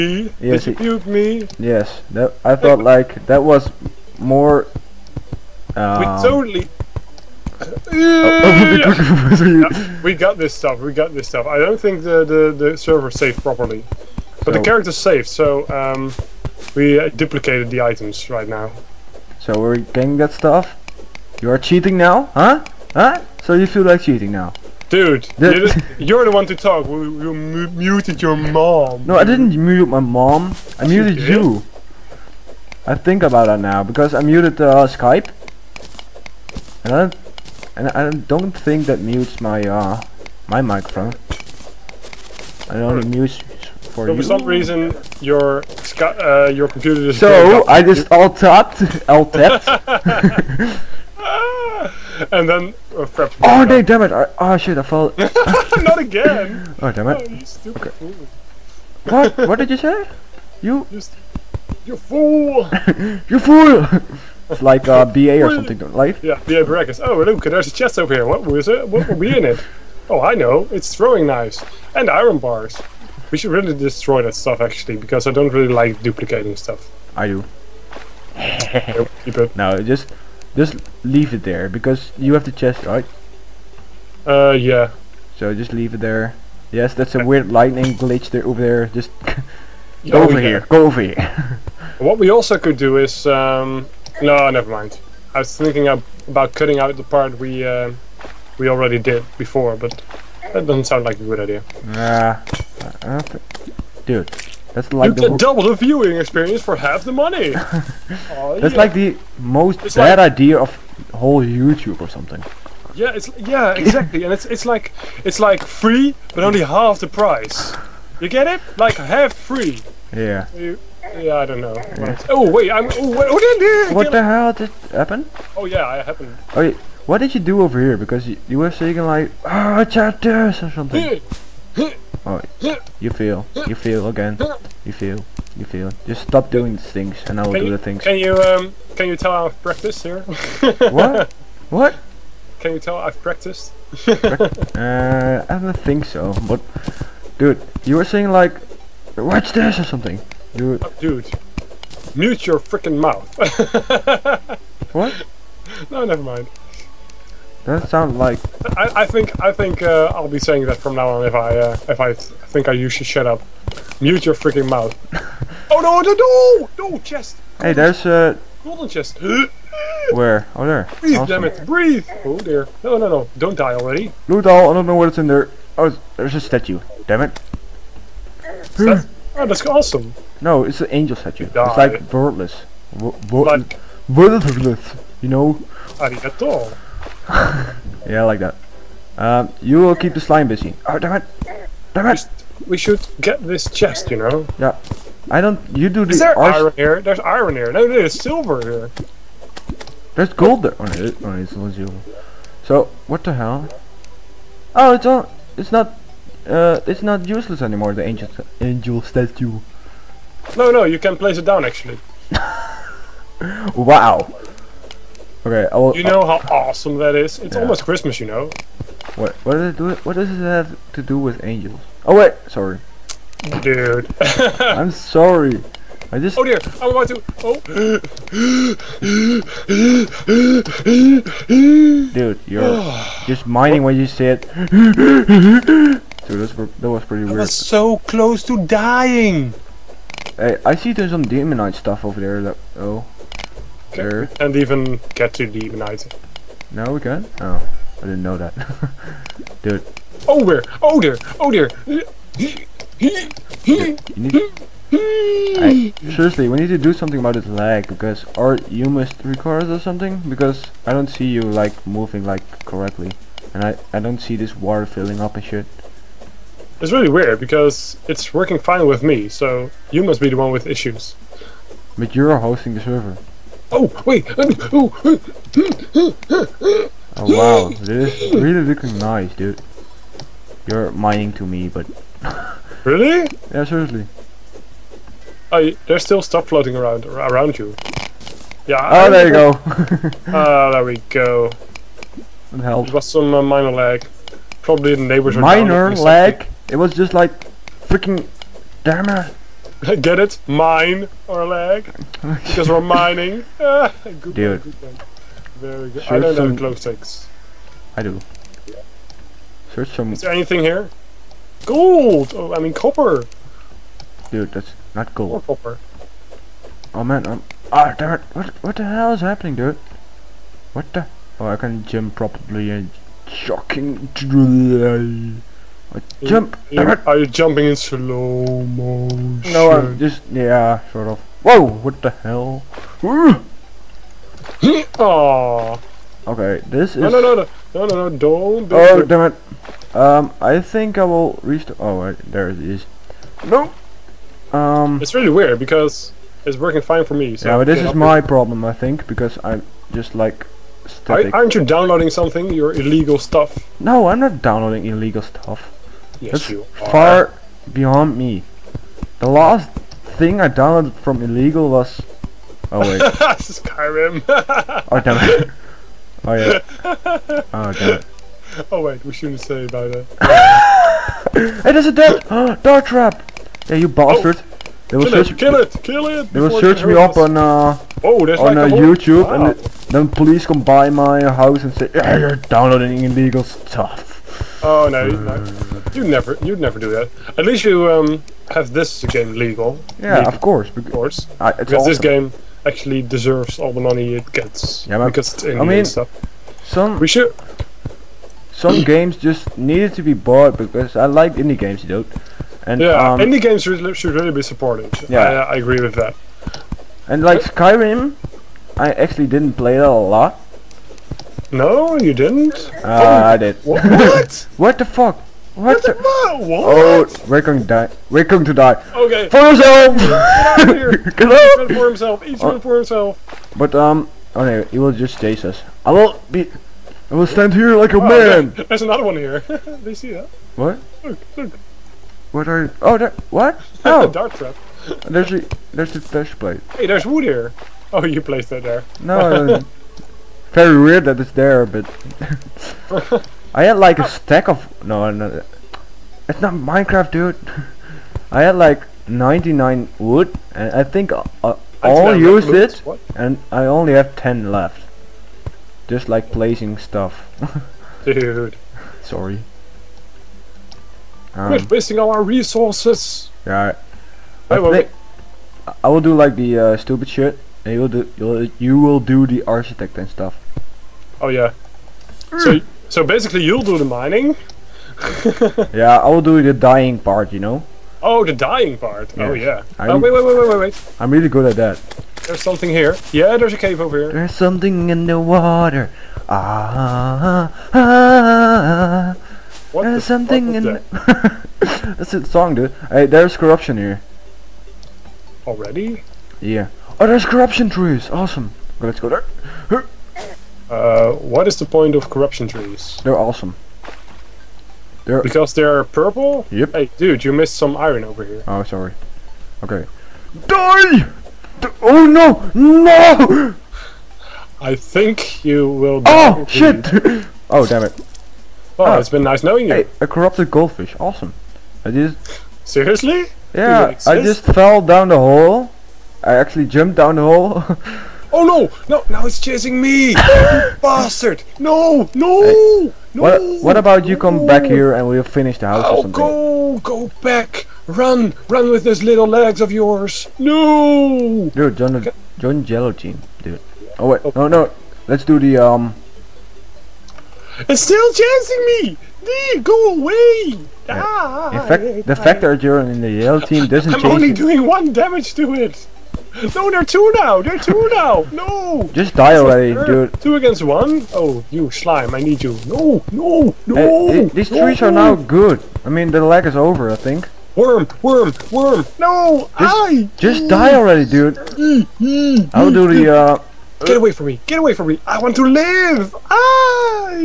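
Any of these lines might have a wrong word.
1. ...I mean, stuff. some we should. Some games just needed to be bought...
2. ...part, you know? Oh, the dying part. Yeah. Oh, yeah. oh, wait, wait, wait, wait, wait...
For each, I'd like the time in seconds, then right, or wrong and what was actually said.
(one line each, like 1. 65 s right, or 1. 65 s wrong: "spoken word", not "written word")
1. 395 s right
2. 476 s right.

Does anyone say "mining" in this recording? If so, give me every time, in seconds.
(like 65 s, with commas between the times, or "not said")
280 s, 302 s, 473 s.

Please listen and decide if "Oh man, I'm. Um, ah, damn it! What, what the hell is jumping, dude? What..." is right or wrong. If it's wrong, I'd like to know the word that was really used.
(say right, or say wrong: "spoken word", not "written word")
wrong: "happening", not "jumping".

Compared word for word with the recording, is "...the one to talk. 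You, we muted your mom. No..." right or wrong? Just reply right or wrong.
right.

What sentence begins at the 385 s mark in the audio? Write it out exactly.
You never, you'd never do that.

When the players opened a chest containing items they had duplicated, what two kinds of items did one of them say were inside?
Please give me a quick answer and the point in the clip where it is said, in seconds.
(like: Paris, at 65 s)
Throwing knives and iron bars, at 70 s.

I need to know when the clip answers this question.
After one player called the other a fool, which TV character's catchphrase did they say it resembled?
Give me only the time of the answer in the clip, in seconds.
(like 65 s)
66 s.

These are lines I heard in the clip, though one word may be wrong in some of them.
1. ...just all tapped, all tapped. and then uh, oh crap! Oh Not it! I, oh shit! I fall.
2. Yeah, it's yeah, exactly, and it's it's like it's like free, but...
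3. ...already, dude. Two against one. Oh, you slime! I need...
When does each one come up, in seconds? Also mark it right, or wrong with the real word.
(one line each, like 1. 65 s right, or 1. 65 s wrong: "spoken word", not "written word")
1. 47 s wrong: "Damn", not "Not"
2. 112 s right
3. 559 s right.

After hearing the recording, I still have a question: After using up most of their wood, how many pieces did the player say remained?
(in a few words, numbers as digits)
10.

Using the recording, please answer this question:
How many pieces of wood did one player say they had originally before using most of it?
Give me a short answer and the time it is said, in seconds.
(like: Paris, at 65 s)
99, at 449 s.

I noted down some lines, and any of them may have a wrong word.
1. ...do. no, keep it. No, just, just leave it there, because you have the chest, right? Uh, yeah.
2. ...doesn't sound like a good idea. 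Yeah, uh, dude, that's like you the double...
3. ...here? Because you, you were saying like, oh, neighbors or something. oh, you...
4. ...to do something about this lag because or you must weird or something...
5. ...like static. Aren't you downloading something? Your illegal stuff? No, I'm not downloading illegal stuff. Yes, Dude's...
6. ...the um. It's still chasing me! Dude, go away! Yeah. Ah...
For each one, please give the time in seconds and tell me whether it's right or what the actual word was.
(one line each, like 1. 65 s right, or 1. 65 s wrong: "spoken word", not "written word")
1. 77 s right
2. 100 s right
3. 127 s wrong: "chapters", not "neighbors"
4. 256 s wrong: "record", not "weird"
5. 350 s wrong: "That", not "Dude"
6. 545 s right.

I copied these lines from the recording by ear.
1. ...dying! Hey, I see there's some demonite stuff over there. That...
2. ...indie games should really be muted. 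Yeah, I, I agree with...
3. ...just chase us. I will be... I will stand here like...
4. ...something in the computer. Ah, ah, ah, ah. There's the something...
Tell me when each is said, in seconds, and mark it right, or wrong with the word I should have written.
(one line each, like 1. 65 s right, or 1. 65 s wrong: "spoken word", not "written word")
1. 238 s right
2. 403 s wrong: "supported", not "muted"
3. 424 s right
4. 484 s wrong: "water", not "computer".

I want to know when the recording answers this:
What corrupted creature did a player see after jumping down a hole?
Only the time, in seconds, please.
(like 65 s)
520 s.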